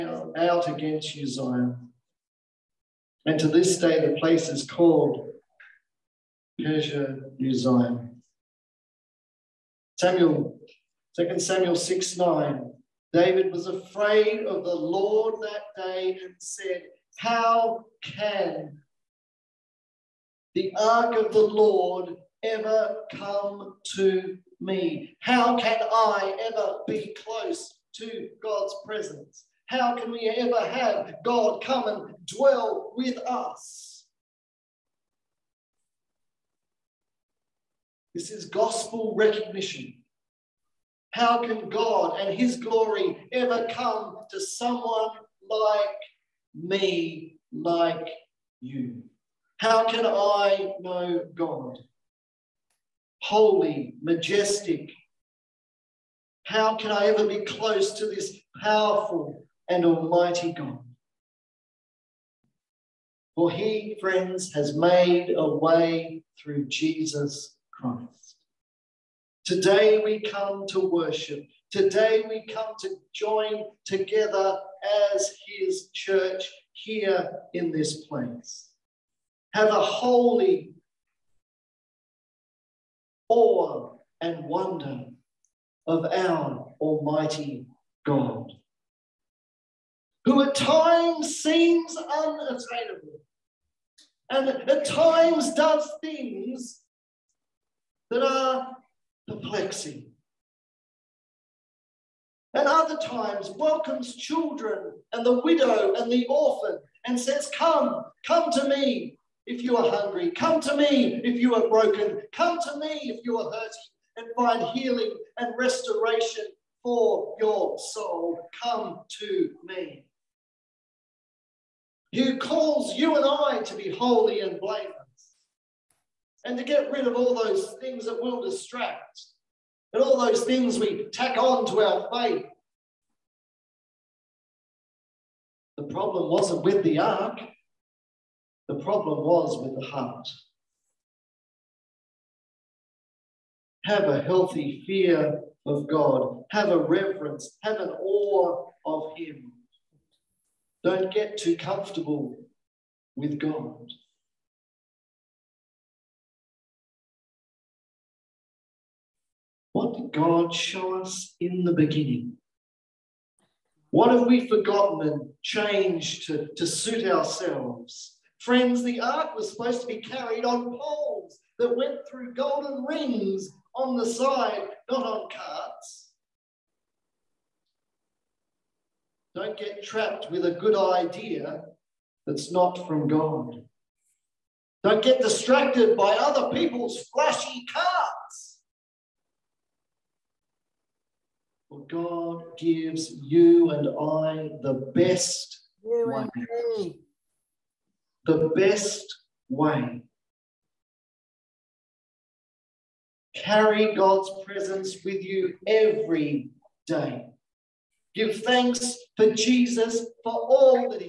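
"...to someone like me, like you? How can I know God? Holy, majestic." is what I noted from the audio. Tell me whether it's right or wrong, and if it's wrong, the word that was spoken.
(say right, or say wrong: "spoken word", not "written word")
right.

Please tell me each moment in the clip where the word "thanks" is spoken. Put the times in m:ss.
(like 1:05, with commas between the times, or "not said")
3:28.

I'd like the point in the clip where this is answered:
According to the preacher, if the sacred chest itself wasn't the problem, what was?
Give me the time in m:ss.
2:19.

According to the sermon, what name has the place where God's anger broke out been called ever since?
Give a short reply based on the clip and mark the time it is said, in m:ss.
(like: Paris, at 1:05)
Perez Uzziah, at 0:06.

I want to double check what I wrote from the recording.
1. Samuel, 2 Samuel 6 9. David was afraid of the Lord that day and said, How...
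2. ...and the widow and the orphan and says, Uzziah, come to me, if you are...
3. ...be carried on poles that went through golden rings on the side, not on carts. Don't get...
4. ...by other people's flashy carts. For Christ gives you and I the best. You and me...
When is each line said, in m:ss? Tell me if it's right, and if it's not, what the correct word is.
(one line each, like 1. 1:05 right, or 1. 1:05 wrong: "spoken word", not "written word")
1. 0:10 right
2. 1:45 wrong: "Come", not "Uzziah"
3. 2:49 right
4. 3:05 wrong: "God", not "Christ".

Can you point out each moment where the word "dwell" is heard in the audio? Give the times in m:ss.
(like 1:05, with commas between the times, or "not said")
0:32.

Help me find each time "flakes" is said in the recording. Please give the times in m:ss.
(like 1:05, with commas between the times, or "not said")
not said.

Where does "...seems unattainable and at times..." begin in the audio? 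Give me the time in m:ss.
1:31.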